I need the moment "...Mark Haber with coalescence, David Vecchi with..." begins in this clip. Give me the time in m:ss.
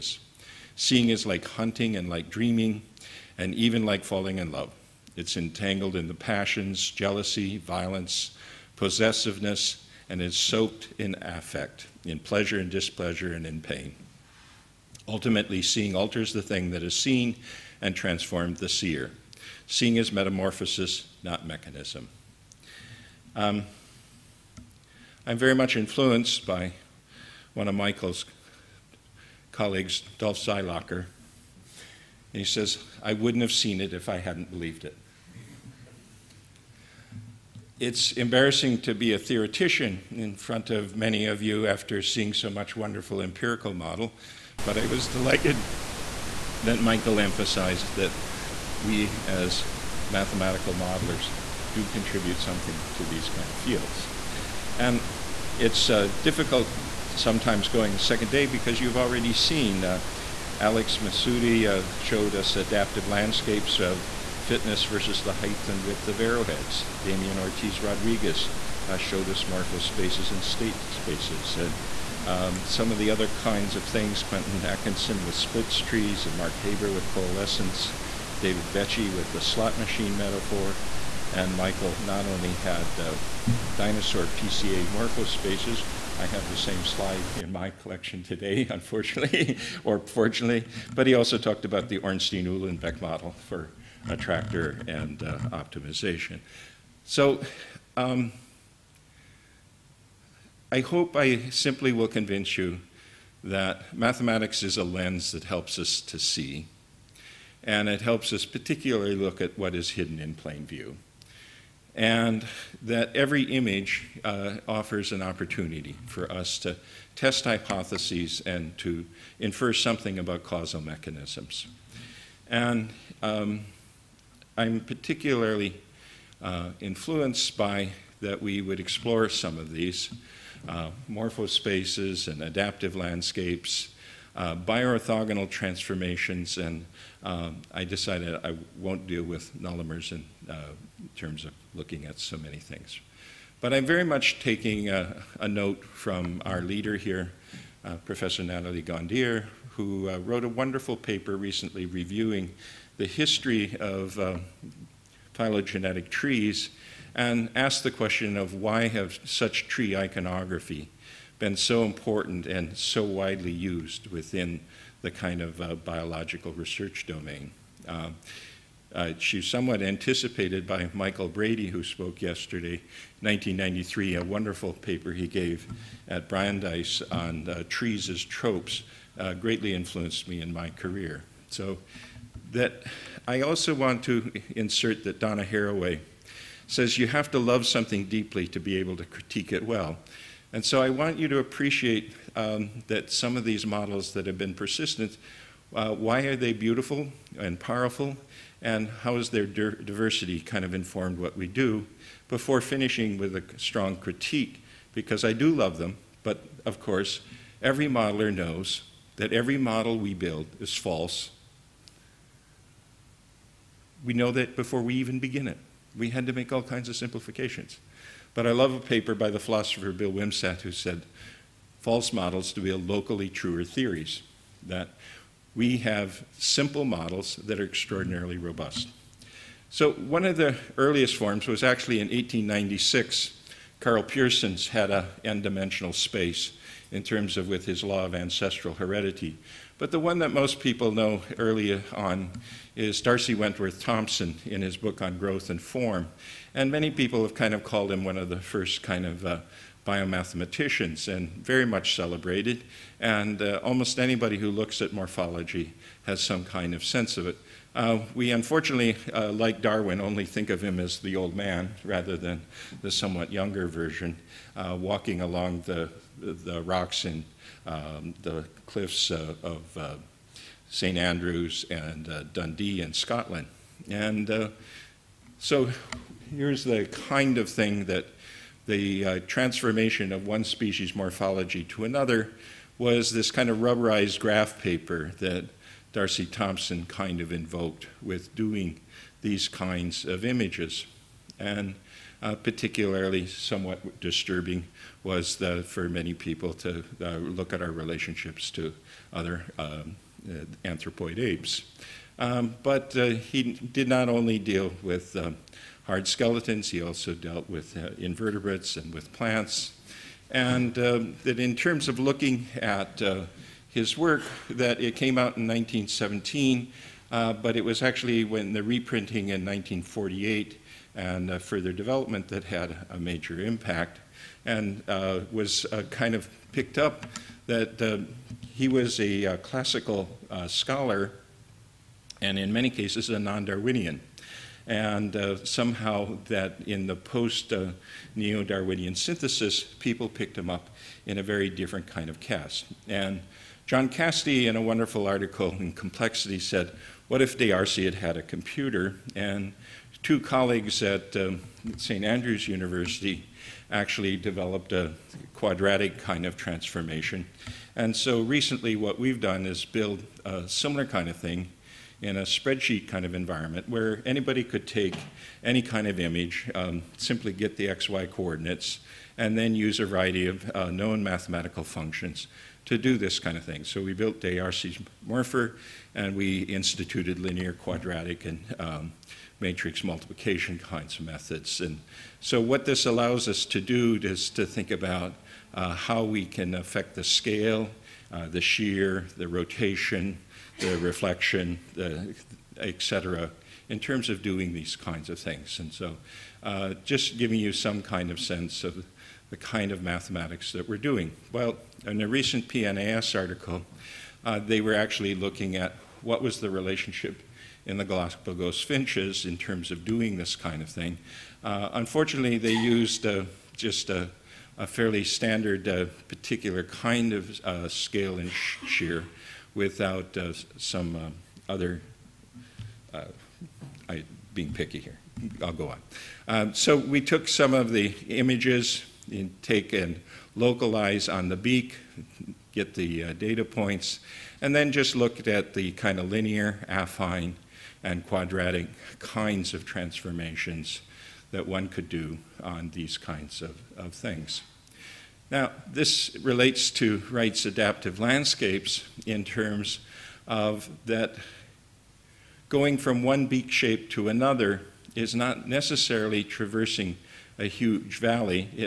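1:16.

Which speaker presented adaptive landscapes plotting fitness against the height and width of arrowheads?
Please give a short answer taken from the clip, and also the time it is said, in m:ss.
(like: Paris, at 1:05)
Alex Mesoudi, at 1:00.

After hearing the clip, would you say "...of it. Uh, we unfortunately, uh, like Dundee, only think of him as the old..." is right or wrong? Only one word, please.
wrong.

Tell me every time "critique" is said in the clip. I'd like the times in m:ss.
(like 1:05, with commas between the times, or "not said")
3:09, 3:23.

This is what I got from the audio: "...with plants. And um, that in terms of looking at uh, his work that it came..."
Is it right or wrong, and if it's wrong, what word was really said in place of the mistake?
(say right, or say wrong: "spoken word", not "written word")
right.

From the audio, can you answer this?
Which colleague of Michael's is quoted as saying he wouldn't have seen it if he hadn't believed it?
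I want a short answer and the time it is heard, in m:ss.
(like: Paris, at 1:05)
Dolph Seilacher, at 0:30.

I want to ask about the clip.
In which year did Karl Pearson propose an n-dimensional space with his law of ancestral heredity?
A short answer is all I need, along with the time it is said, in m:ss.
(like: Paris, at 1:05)
1896, at 3:52.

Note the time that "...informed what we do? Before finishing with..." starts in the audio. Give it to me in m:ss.
3:20.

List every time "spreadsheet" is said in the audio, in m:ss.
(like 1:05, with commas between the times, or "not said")
6:02.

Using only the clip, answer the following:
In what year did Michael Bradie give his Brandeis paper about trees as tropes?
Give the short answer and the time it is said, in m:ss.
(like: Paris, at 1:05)
1993, at 2:53.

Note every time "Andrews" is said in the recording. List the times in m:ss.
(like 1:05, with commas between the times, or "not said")
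4:30, 5:52.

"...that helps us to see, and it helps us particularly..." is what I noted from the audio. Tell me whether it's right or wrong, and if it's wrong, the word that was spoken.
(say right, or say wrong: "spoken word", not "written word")
right.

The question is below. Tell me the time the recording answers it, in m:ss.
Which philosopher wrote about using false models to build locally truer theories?
3:39.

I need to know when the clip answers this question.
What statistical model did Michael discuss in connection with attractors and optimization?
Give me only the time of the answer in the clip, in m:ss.
1:31.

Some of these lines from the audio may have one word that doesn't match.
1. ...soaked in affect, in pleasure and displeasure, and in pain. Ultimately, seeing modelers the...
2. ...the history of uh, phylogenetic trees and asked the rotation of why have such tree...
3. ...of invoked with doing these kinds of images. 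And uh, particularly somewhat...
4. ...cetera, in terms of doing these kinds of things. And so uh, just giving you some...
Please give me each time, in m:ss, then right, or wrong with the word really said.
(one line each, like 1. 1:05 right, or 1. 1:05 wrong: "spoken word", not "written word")
1. 0:10 wrong: "alters", not "modelers"
2. 2:32 wrong: "question", not "rotation"
3. 4:47 right
4. 6:32 right.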